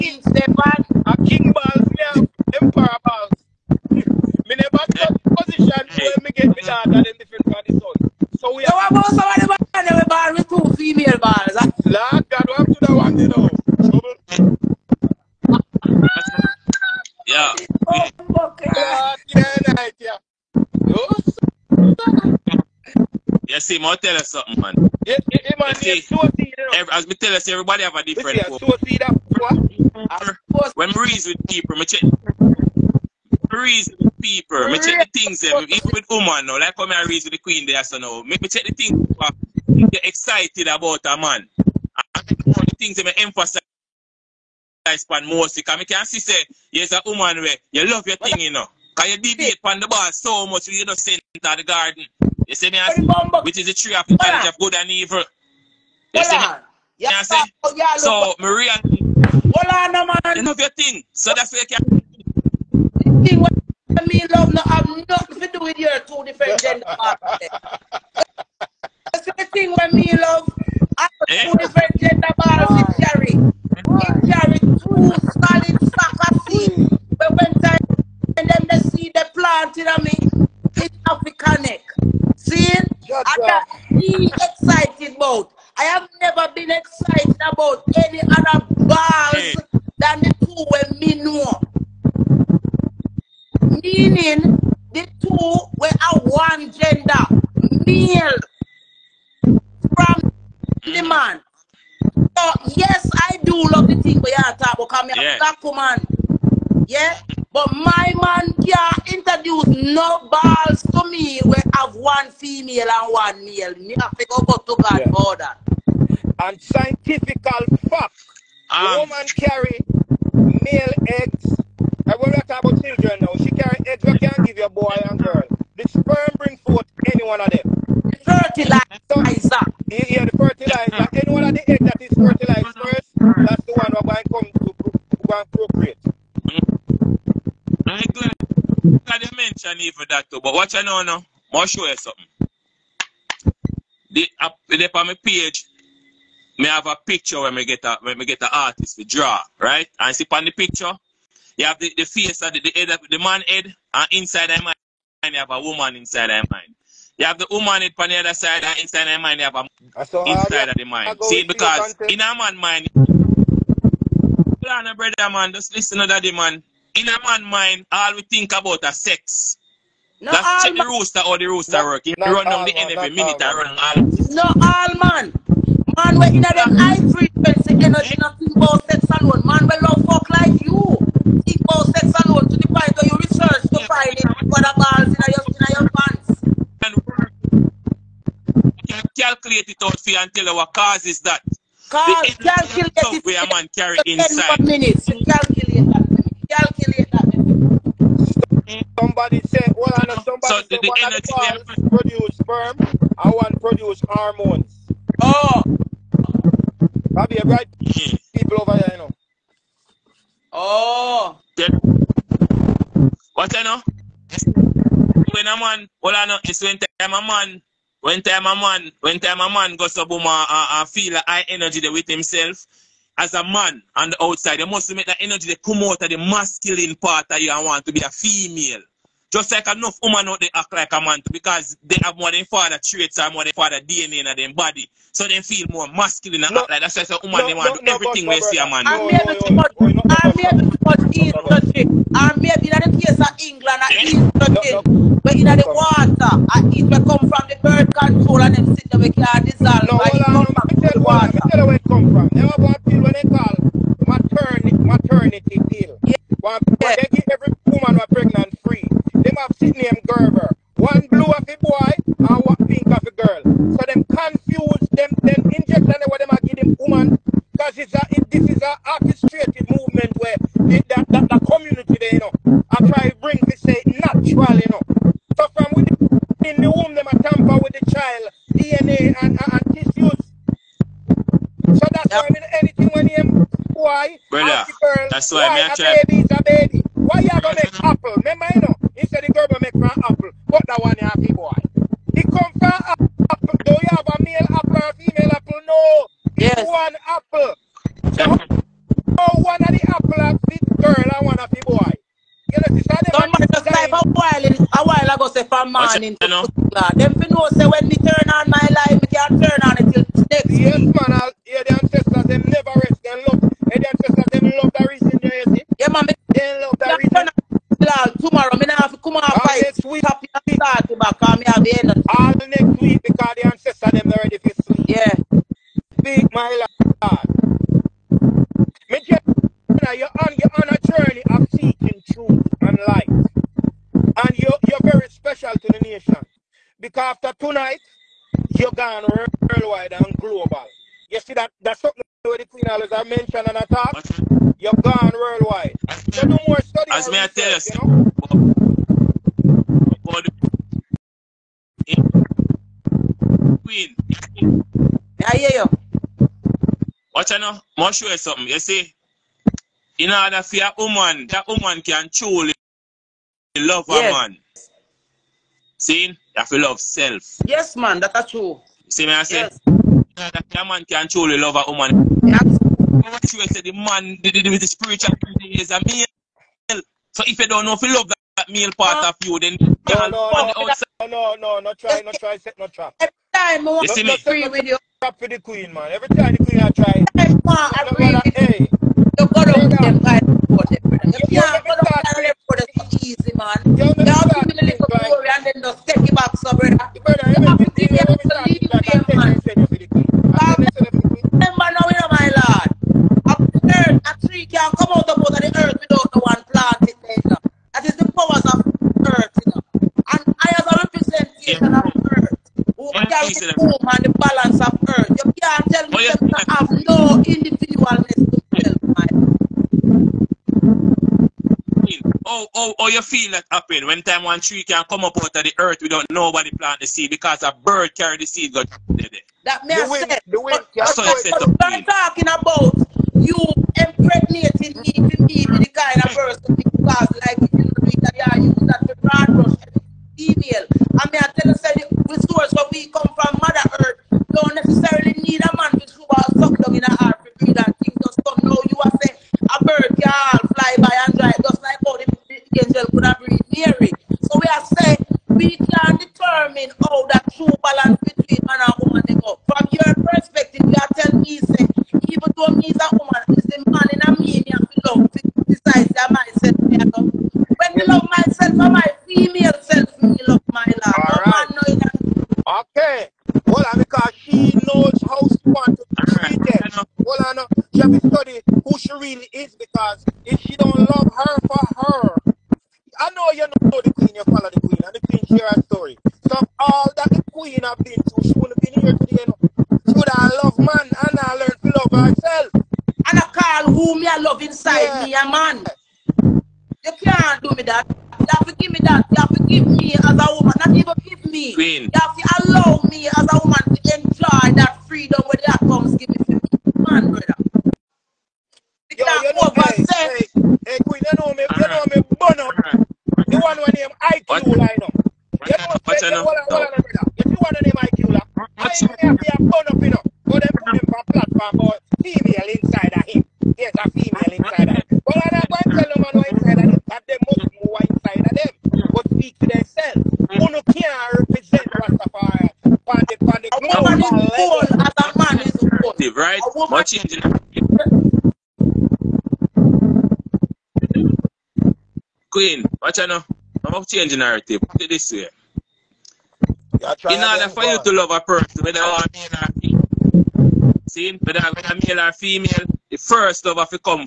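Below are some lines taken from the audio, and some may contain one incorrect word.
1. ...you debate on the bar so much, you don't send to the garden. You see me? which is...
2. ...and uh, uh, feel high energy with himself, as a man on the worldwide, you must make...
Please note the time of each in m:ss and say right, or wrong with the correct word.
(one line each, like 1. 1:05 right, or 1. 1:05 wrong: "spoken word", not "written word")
1. 0:49 right
2. 3:40 wrong: "outside", not "worldwide".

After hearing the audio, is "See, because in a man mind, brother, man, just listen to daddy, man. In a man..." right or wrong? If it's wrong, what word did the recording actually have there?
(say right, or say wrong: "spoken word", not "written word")
right.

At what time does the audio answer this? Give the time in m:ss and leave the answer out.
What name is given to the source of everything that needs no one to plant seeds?
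7:23.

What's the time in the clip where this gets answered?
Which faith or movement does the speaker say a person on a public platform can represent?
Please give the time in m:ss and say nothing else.
8:51.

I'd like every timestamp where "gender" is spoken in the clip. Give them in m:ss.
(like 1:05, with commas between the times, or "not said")
1:06, 1:11, 1:36.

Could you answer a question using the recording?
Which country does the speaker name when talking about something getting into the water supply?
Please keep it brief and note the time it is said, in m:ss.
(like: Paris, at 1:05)
England, at 4:03.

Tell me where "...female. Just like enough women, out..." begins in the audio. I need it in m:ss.
3:48.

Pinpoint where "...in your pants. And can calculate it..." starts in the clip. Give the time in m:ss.
3:05.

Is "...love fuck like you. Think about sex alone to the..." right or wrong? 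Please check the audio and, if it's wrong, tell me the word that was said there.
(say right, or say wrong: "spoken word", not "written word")
right.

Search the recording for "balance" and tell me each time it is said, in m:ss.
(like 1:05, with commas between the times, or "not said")
6:54, 7:37.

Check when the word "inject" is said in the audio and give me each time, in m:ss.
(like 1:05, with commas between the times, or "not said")
4:25.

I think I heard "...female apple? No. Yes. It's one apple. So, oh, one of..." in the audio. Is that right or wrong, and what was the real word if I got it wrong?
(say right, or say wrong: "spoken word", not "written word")
right.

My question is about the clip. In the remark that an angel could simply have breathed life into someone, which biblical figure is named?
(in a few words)
Mary.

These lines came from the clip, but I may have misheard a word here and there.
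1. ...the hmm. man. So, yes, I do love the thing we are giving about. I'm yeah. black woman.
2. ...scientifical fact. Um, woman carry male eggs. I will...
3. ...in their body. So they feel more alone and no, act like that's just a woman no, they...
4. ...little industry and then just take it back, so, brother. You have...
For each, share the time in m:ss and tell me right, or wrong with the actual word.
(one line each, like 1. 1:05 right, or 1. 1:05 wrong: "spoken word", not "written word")
1. 1:40 wrong: "talking", not "giving"
2. 1:56 right
3. 3:54 wrong: "masculine", not "alone"
4. 6:34 wrong: "glory", not "industry".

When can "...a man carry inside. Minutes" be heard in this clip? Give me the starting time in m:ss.
3:13.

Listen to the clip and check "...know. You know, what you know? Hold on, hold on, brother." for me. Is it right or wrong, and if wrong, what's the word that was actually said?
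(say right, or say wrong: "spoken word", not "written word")
right.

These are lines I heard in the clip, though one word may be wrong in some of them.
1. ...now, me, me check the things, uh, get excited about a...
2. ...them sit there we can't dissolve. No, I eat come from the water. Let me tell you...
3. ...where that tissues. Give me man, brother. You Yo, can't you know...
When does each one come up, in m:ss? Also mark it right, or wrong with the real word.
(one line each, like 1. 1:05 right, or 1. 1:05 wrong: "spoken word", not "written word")
1. 0:37 right
2. 4:08 right
3. 8:25 wrong: "comes", not "tissues".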